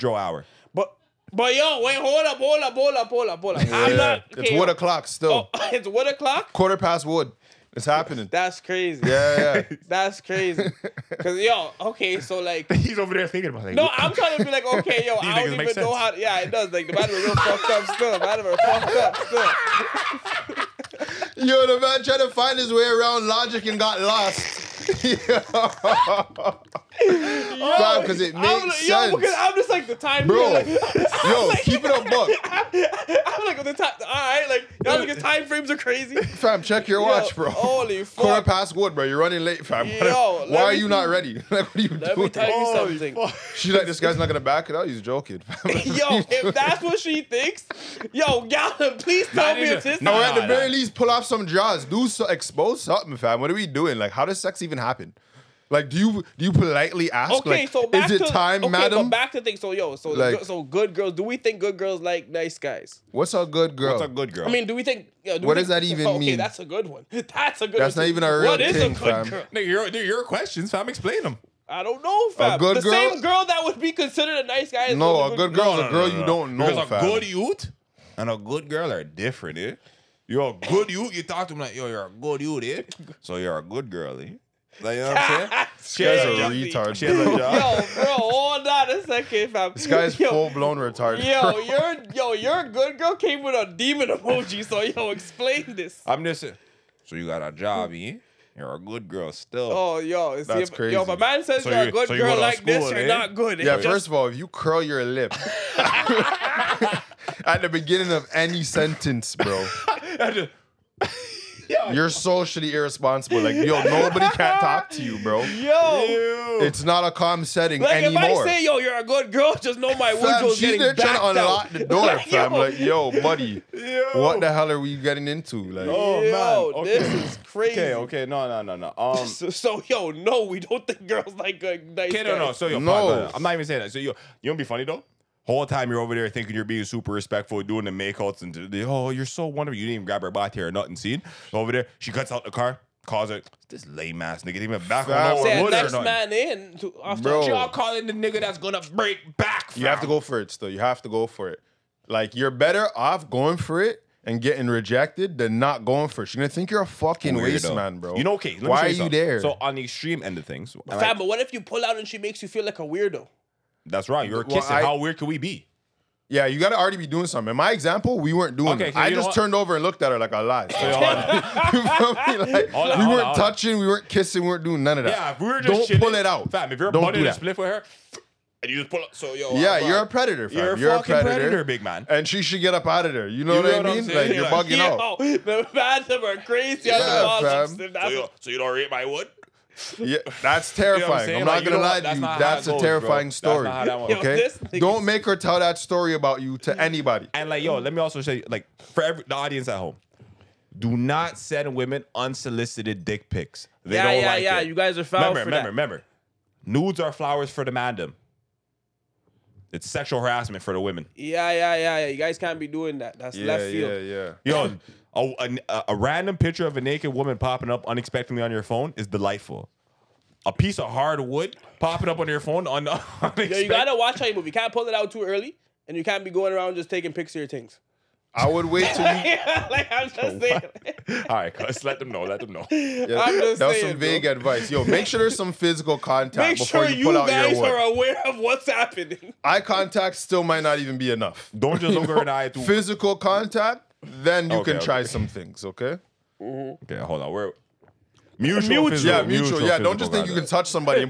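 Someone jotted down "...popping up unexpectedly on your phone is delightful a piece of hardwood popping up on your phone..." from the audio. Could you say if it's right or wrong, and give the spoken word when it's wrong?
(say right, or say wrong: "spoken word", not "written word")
right.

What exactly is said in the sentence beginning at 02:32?
Like you're better off going for it and getting rejected than not going for it.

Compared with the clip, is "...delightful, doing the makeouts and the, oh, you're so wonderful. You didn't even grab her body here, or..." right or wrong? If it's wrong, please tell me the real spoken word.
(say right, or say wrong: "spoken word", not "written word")
wrong: "respectful", not "delightful".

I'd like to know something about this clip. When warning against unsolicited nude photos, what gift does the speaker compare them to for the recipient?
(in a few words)
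Flowers.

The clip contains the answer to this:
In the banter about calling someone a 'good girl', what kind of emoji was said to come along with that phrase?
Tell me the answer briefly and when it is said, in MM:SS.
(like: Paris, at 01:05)
Demon emoji, at 01:33.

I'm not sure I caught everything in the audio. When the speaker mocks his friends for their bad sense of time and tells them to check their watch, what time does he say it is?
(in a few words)
Quarter past one.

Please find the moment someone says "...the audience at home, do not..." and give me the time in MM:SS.
03:19.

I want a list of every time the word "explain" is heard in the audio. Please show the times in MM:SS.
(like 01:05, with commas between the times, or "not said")
01:10, 01:35.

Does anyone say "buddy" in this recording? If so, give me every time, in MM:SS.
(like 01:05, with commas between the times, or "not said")
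02:03, 02:56.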